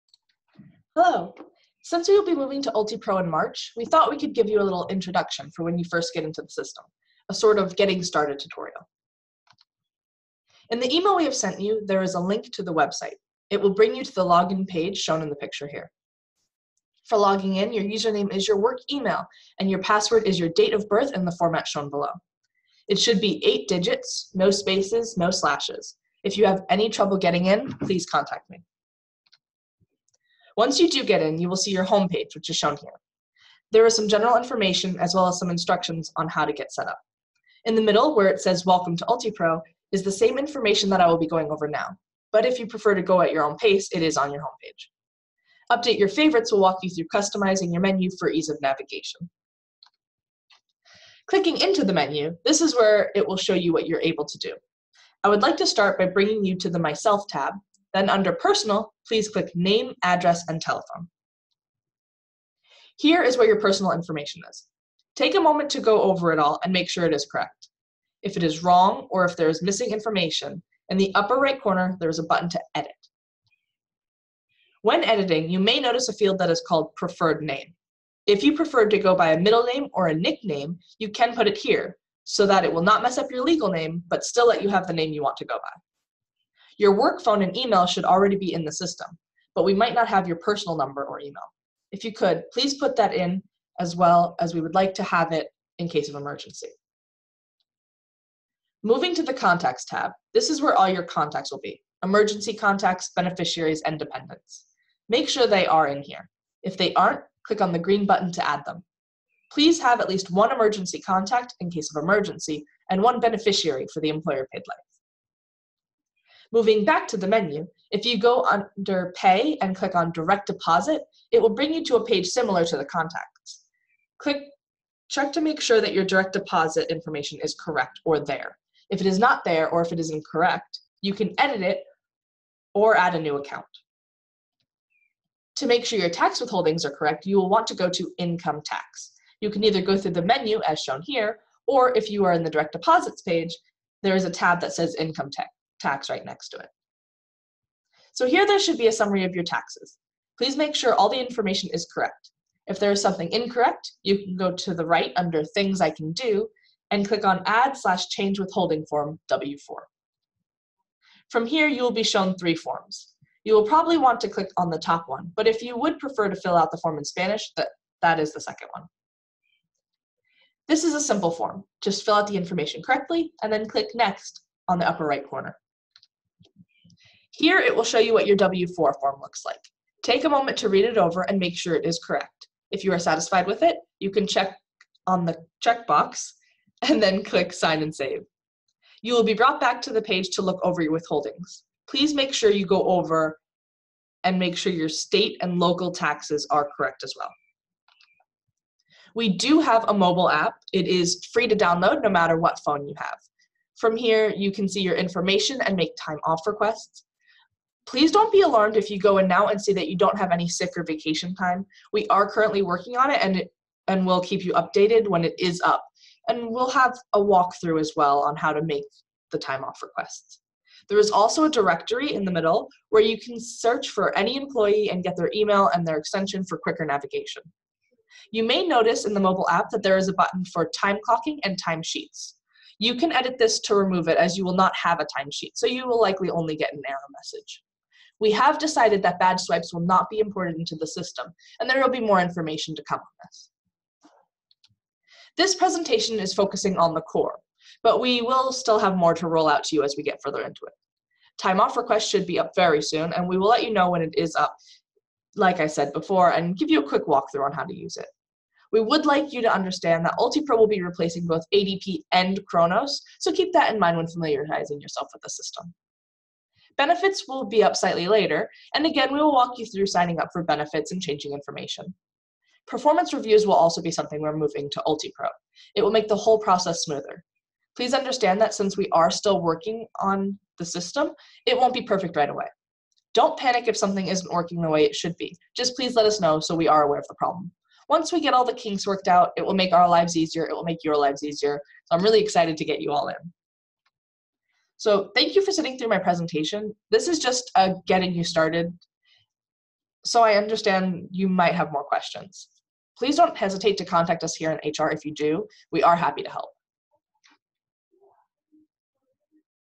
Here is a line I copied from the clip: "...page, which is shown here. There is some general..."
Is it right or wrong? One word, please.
right.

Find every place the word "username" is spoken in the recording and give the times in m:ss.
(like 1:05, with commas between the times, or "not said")
0:17.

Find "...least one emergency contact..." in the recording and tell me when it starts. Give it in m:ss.
1:50.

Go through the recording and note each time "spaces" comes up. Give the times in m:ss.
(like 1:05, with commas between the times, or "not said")
0:24.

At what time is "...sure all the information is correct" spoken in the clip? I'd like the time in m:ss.
2:30.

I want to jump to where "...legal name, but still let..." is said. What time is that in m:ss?
1:23.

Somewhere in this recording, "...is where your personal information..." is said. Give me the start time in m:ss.
1:03.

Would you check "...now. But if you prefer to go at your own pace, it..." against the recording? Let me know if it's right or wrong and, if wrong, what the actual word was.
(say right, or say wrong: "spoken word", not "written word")
right.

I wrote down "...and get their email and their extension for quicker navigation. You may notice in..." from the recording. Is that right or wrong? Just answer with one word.
right.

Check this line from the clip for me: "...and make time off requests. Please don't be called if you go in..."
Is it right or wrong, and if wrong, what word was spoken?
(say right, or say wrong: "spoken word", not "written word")
wrong: "alarmed", not "called".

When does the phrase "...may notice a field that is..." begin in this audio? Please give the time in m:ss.
1:15.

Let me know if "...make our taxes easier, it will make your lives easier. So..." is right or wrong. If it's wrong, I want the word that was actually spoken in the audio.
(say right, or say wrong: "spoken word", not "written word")
wrong: "lives", not "taxes".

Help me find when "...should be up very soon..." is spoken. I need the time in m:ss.
4:12.